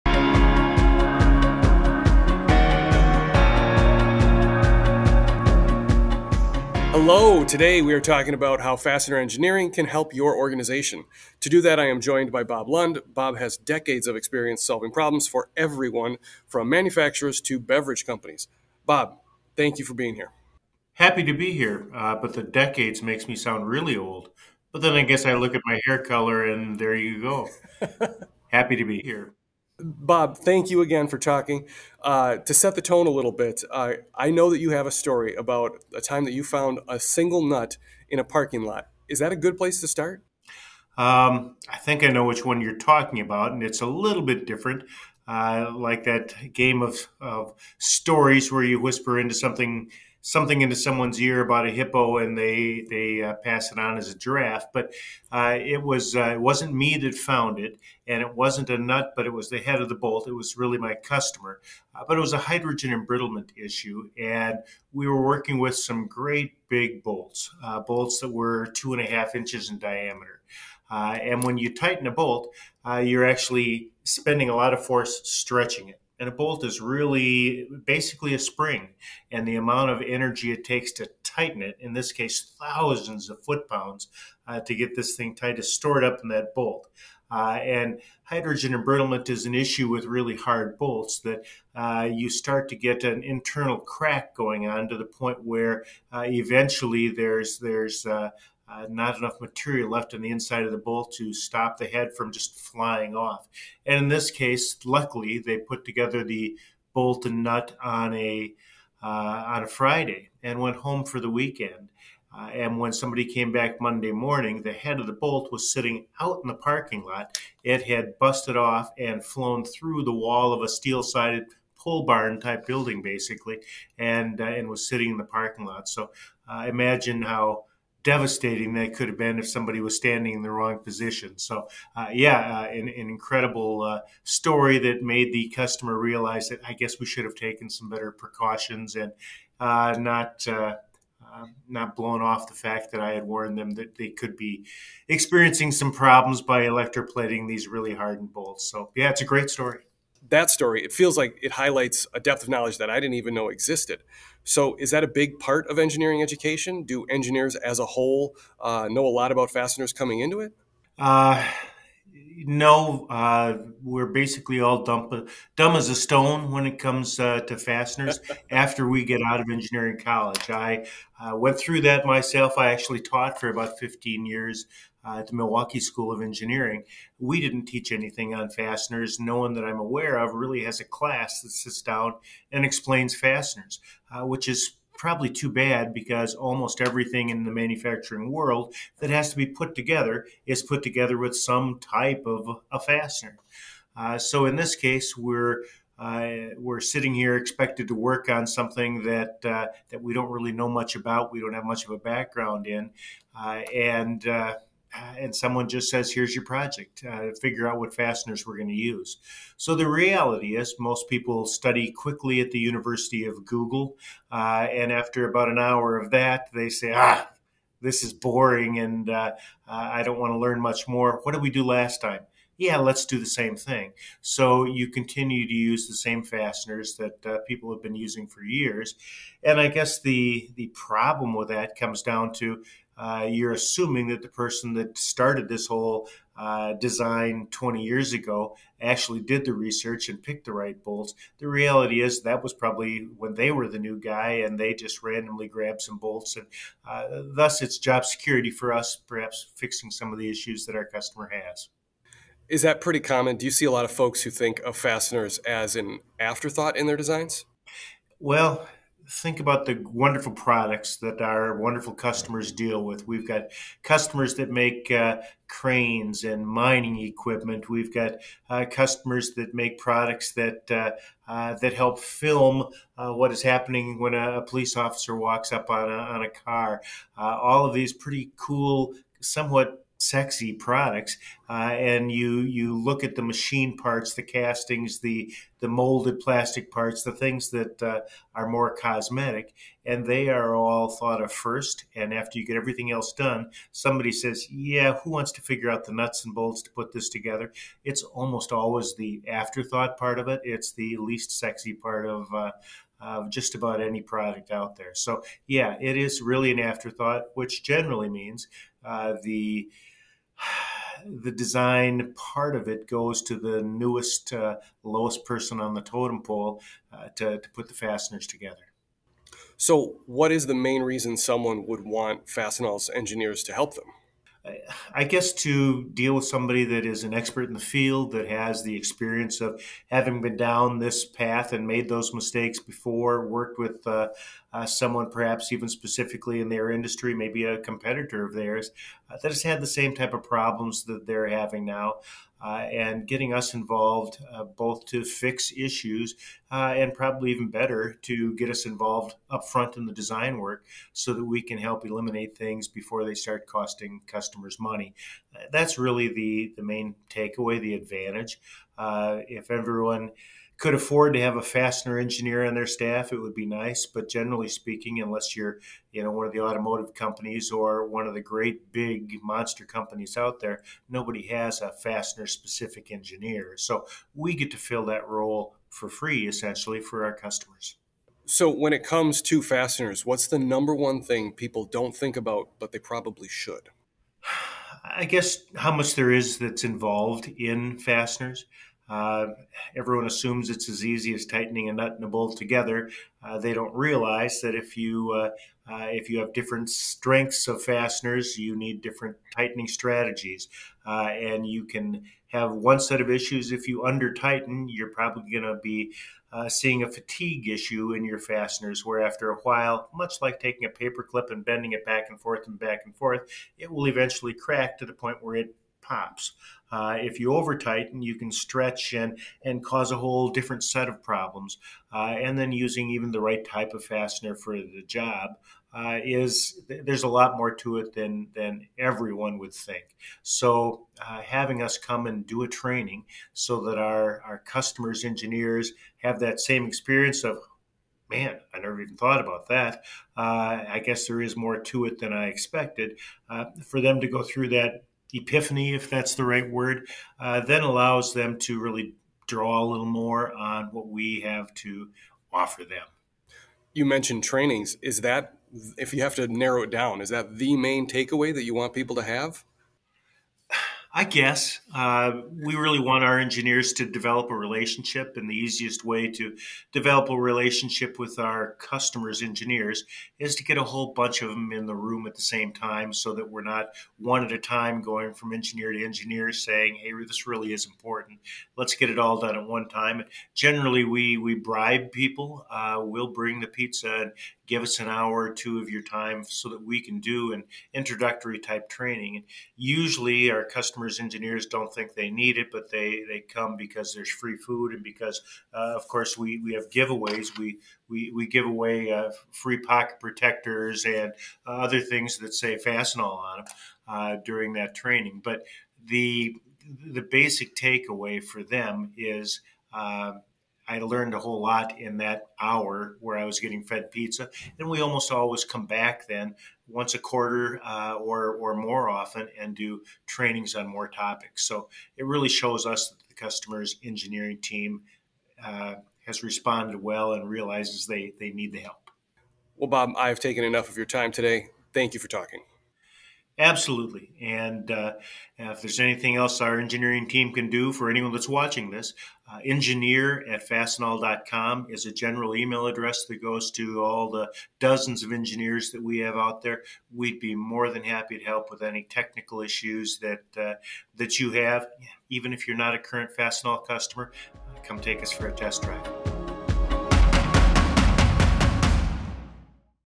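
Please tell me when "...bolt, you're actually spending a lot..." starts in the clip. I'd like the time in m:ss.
1:12.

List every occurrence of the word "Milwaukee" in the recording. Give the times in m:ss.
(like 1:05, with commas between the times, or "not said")
2:55.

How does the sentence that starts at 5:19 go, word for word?
So, what is the main reason someone would want Fastenal's engineers to help them?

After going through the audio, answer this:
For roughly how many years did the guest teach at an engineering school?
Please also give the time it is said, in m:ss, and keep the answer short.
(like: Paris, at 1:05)
15, at 2:53.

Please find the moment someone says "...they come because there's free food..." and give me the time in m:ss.
8:13.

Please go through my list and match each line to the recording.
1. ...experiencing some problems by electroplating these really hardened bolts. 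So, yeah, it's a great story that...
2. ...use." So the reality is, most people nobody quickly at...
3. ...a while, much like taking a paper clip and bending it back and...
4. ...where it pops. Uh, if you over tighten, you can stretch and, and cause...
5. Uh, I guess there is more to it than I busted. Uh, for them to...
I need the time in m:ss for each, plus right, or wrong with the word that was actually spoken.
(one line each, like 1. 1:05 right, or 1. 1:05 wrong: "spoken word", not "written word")
1. 2:25 right
2. 3:28 wrong: "study", not "nobody"
3. 6:49 right
4. 6:55 right
5. 7:20 wrong: "expected", not "busted".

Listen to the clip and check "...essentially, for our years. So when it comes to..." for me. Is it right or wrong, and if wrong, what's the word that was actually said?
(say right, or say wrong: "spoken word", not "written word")
wrong: "customers", not "years".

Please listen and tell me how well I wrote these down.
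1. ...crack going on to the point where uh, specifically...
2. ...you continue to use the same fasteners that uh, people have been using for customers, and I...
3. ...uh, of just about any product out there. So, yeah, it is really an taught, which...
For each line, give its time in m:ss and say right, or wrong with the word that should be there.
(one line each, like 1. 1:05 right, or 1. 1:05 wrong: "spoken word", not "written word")
1. 1:33 wrong: "eventually", not "specifically"
2. 3:44 wrong: "years", not "customers"
3. 5:02 wrong: "afterthought", not "taught".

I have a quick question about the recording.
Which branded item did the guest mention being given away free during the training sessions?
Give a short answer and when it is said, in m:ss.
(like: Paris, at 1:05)
pocket protectors, at 8:19.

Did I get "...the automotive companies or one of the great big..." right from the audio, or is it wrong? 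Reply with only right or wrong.
right.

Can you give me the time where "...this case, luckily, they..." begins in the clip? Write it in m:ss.
1:44.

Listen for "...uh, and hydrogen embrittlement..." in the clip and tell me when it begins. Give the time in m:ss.
1:27.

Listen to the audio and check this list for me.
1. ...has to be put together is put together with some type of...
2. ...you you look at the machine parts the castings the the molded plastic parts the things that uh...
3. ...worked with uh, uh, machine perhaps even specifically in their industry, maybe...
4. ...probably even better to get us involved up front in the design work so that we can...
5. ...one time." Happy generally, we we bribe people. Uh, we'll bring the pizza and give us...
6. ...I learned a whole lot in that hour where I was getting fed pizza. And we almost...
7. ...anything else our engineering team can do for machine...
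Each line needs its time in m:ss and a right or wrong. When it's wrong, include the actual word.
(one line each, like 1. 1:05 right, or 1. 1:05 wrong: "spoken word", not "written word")
1. 3:09 right
2. 4:42 right
3. 5:33 wrong: "someone", not "machine"
4. 5:46 right
5. 7:59 wrong: "And", not "Happy"
6. 8:30 right
7. 8:55 wrong: "anyone", not "machine".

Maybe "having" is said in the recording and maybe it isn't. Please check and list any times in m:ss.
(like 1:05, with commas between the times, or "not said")
5:29, 5:41, 7:11.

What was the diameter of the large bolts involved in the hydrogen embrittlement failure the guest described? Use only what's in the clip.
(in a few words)
2.5 inches.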